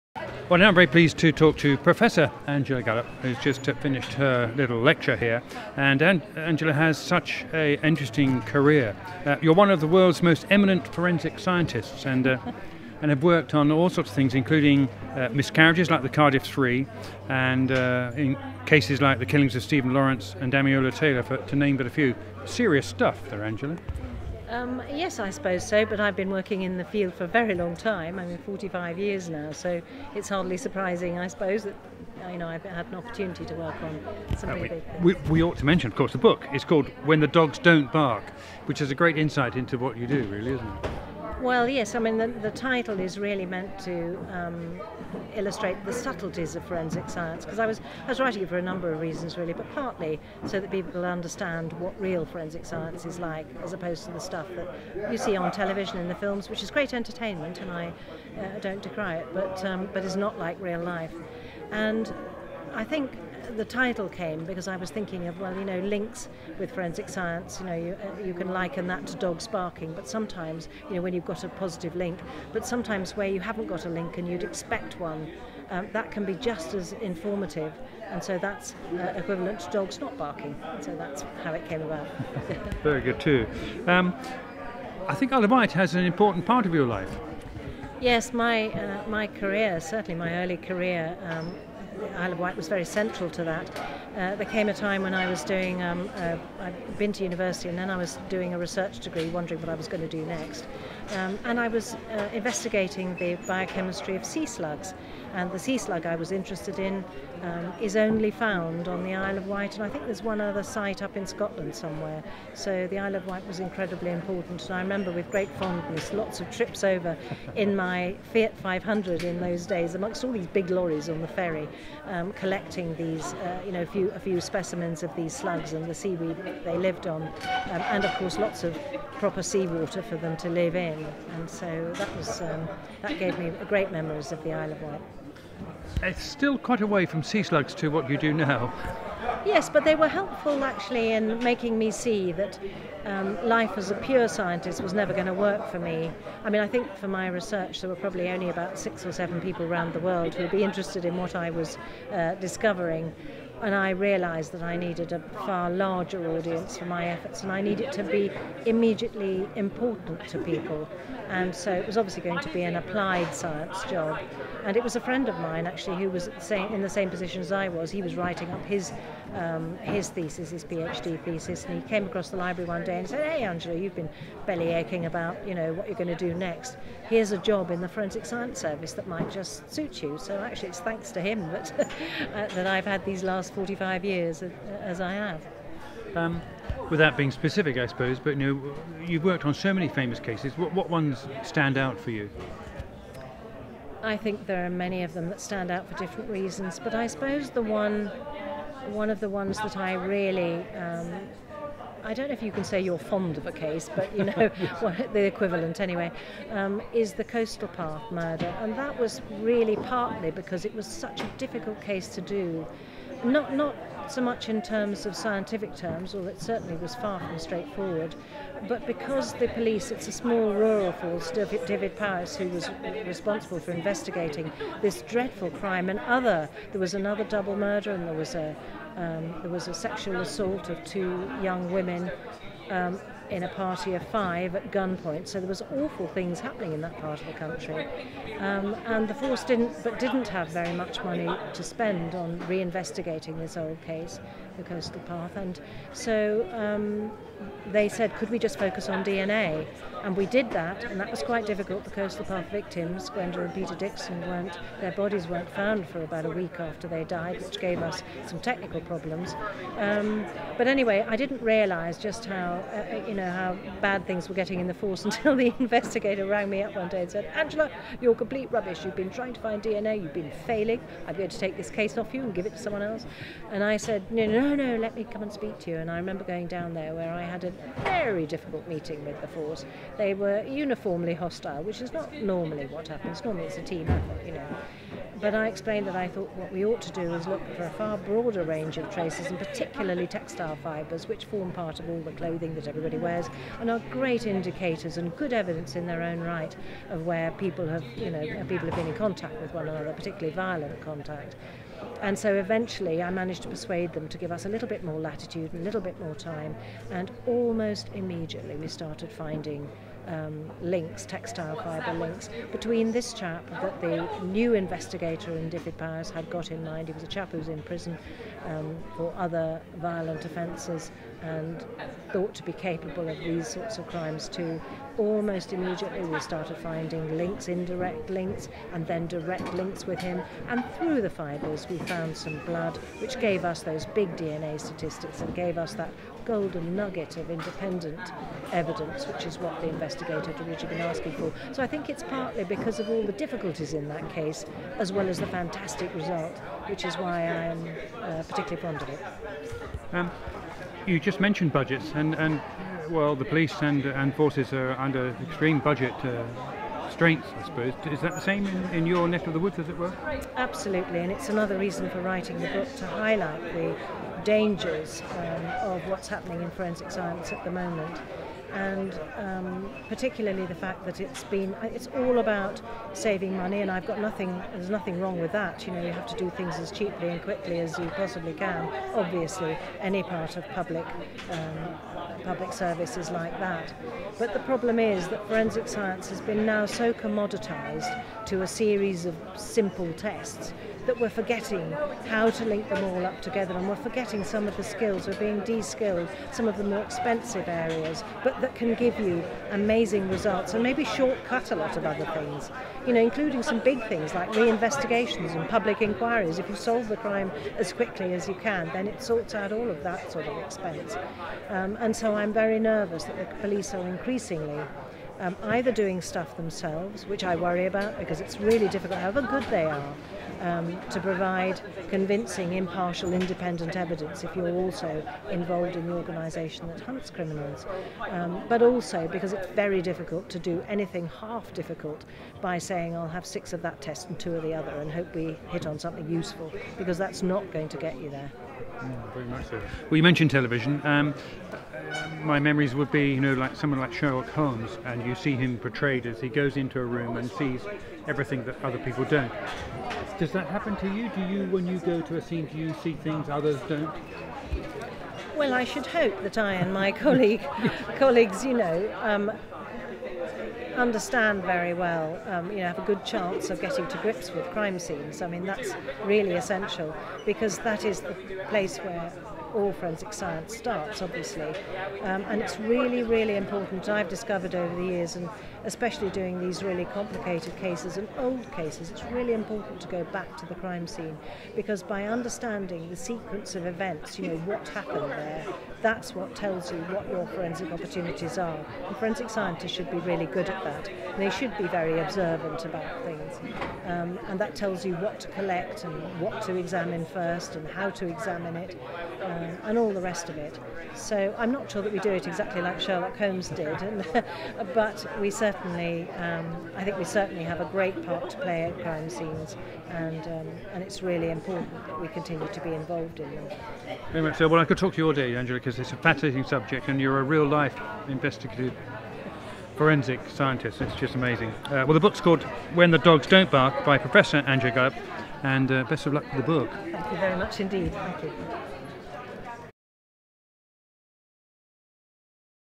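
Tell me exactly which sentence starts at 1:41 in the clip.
Um, and I was uh, investigating the biochemistry of sea slugs.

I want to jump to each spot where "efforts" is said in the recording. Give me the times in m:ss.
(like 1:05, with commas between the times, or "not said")
2:37, 4:43.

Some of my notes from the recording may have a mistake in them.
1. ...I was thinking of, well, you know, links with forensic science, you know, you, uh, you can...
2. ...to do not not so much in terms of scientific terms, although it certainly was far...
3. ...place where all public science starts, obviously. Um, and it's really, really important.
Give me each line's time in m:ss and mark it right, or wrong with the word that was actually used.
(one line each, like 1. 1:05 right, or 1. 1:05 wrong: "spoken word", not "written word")
1. 1:04 right
2. 3:32 right
3. 7:48 wrong: "forensic", not "public".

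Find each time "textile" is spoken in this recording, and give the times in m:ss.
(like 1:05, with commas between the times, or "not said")
4:50, 5:11.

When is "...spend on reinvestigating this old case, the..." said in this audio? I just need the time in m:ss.
4:01.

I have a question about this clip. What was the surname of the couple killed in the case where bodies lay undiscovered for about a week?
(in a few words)
Dixon.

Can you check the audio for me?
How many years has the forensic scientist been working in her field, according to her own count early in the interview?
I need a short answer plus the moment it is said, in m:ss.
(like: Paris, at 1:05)
45, at 0:28.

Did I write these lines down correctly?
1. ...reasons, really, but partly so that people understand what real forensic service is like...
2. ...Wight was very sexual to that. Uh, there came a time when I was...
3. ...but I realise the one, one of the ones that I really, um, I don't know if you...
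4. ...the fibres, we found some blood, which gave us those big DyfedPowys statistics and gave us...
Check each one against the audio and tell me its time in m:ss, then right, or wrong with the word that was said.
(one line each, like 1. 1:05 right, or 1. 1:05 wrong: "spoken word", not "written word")
1. 0:49 wrong: "science", not "service"
2. 1:32 wrong: "central", not "sexual"
3. 3:16 wrong: "suppose", not "realise"
4. 5:31 wrong: "DNA", not "DyfedPowys".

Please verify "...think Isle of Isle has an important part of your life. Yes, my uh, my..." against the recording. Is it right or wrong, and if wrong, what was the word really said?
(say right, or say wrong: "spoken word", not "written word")
wrong: "Wight", not "Isle".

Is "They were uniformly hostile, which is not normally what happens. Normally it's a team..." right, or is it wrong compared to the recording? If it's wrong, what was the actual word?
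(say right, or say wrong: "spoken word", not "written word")
right.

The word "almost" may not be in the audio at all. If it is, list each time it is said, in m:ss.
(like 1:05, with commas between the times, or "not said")
5:07, 5:24.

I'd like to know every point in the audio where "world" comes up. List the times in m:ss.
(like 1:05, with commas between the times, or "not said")
0:09, 2:29.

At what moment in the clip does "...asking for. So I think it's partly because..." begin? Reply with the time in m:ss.
5:40.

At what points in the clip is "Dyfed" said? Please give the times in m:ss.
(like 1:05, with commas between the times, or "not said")
3:41, 5:15.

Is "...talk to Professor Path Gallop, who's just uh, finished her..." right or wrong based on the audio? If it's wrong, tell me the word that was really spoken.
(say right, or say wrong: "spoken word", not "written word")
wrong: "Angela", not "Path".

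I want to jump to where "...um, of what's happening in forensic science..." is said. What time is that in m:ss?
6:05.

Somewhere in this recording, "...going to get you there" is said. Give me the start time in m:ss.
7:17.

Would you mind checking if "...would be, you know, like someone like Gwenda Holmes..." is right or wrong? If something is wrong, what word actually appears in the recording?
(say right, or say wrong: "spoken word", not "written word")
wrong: "Sherlock", not "Gwenda".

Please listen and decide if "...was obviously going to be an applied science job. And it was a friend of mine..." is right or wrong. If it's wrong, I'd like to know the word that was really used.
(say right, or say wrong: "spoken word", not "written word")
right.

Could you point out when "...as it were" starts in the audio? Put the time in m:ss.
5:59.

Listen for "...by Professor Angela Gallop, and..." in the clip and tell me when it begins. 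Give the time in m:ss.
8:43.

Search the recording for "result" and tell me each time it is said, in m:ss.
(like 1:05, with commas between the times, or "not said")
5:45, 6:40.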